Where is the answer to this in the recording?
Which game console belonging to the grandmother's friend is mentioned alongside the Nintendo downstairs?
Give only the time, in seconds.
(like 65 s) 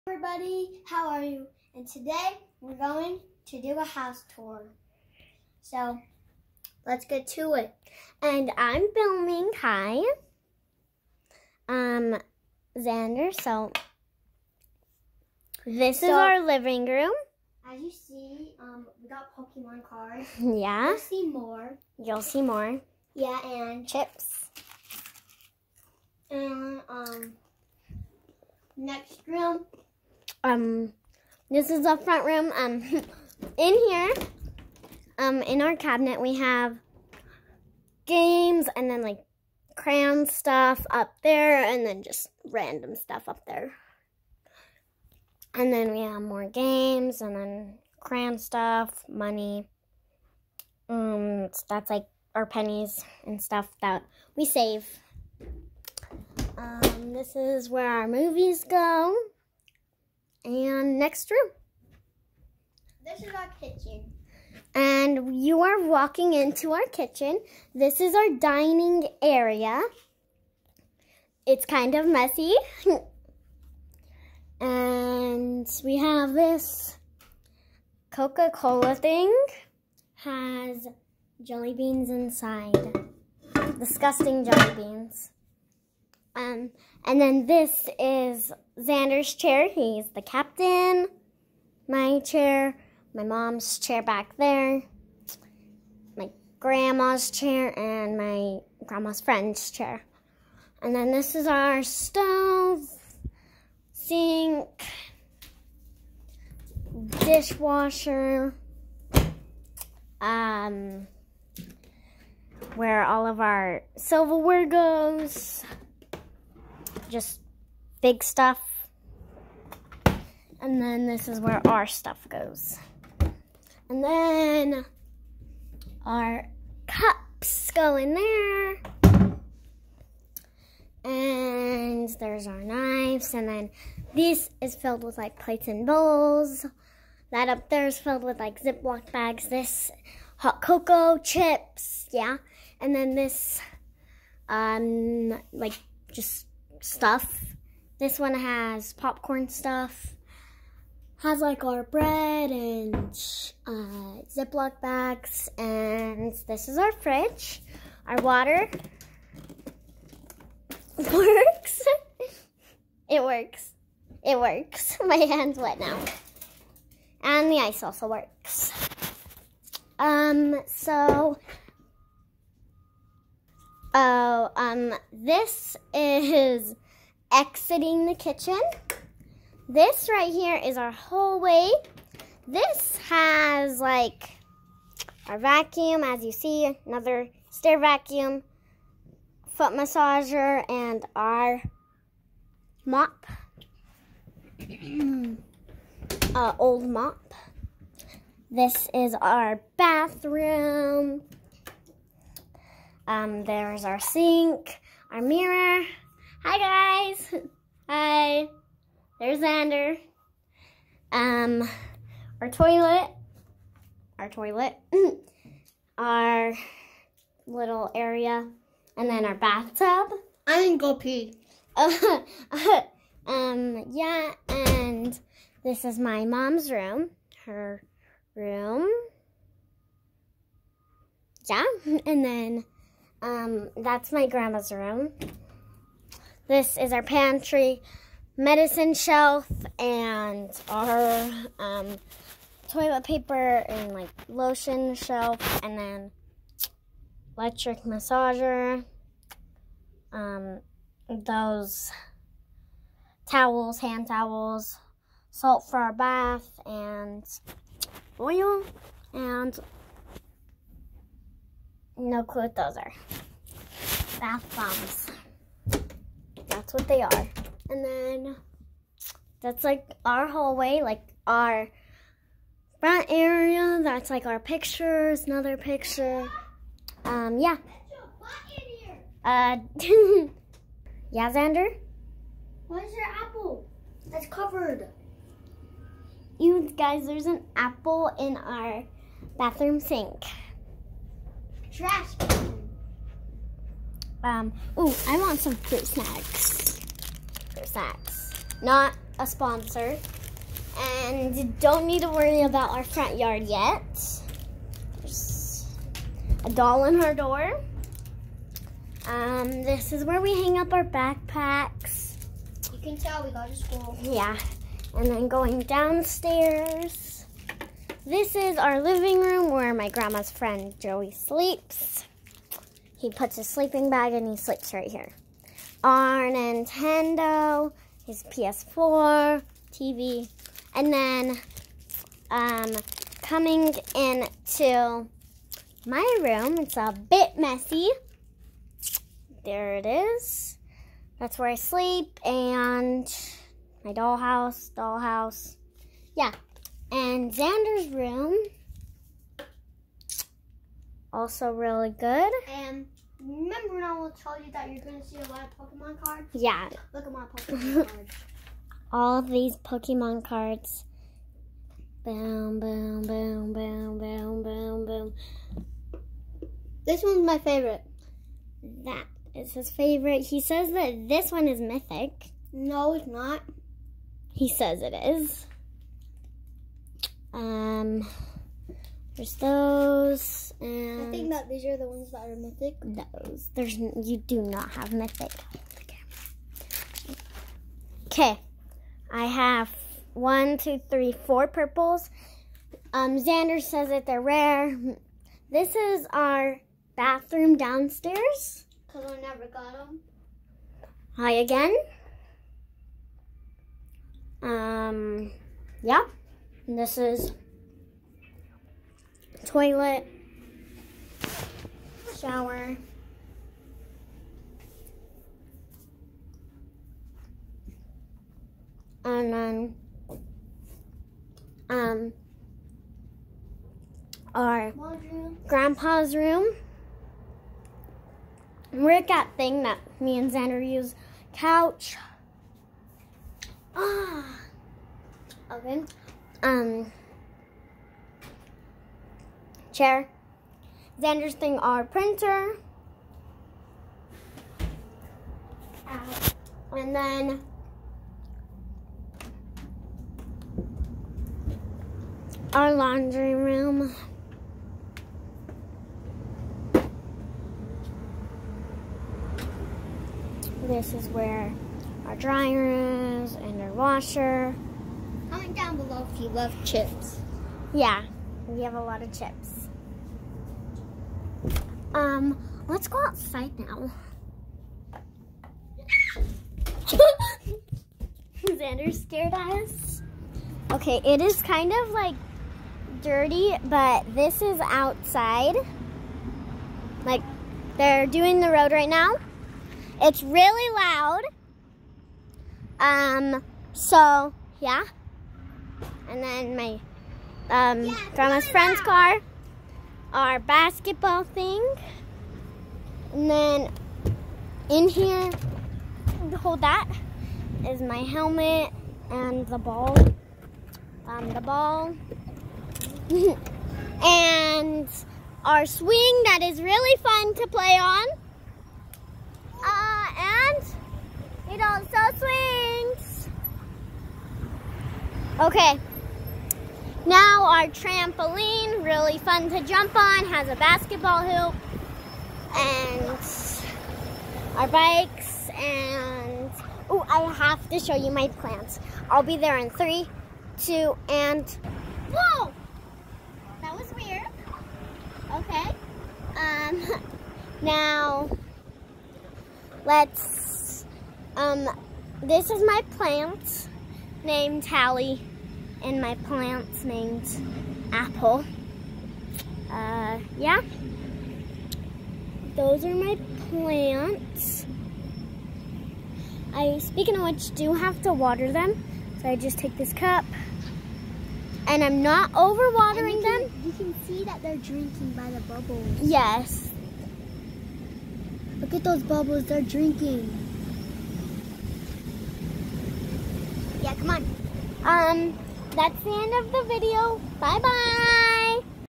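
328 s.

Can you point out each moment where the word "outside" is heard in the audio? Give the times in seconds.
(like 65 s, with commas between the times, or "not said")
473 s, 484 s.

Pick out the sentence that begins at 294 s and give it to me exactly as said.
Um, ooh, I want some fruit snacks.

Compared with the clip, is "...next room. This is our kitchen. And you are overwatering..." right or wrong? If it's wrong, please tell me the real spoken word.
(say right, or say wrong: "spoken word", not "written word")
wrong: "walking", not "overwatering".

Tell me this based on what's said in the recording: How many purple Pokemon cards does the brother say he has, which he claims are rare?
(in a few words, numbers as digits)
4.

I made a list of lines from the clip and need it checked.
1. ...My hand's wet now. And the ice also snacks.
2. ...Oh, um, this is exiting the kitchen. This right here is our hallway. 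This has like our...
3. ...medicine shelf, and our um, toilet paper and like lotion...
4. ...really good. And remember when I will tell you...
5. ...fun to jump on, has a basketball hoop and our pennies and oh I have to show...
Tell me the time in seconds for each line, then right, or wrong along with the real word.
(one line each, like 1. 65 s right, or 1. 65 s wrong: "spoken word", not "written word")
1. 165 s wrong: "works", not "snacks"
2. 173 s right
3. 238 s right
4. 351 s right
5. 529 s wrong: "bikes", not "pennies".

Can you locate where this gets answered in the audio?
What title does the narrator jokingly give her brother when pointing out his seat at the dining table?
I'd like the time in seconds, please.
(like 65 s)
89 s.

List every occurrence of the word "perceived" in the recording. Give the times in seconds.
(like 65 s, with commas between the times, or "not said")
not said.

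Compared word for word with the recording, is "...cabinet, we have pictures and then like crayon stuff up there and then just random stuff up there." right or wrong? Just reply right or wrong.
wrong.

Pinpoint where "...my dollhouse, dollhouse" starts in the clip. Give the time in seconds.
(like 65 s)
343 s.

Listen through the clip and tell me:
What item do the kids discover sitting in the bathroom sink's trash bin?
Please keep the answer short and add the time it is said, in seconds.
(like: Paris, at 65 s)
An apple, at 287 s.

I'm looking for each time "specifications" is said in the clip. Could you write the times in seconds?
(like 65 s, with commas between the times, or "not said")
not said.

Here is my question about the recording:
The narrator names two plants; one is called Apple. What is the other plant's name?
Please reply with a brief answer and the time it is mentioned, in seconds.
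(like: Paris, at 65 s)
Hallie, at 554 s.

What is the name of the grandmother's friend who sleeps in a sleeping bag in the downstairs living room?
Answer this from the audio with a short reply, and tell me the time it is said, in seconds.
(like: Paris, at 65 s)
Joey, at 320 s.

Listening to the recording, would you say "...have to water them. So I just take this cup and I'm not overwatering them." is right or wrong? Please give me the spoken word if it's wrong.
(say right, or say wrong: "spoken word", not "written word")
right.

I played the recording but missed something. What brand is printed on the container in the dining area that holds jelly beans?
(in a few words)
Coca-Cola.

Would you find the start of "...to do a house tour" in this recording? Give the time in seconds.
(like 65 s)
3 s.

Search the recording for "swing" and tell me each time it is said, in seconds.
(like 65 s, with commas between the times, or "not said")
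515 s, 522 s.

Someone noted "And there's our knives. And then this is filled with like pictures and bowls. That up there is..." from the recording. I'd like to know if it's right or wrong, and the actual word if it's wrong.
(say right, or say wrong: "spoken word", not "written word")
wrong: "plates", not "pictures".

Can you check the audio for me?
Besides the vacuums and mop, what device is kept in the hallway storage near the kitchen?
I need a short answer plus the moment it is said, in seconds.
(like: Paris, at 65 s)
Foot massager, at 189 s.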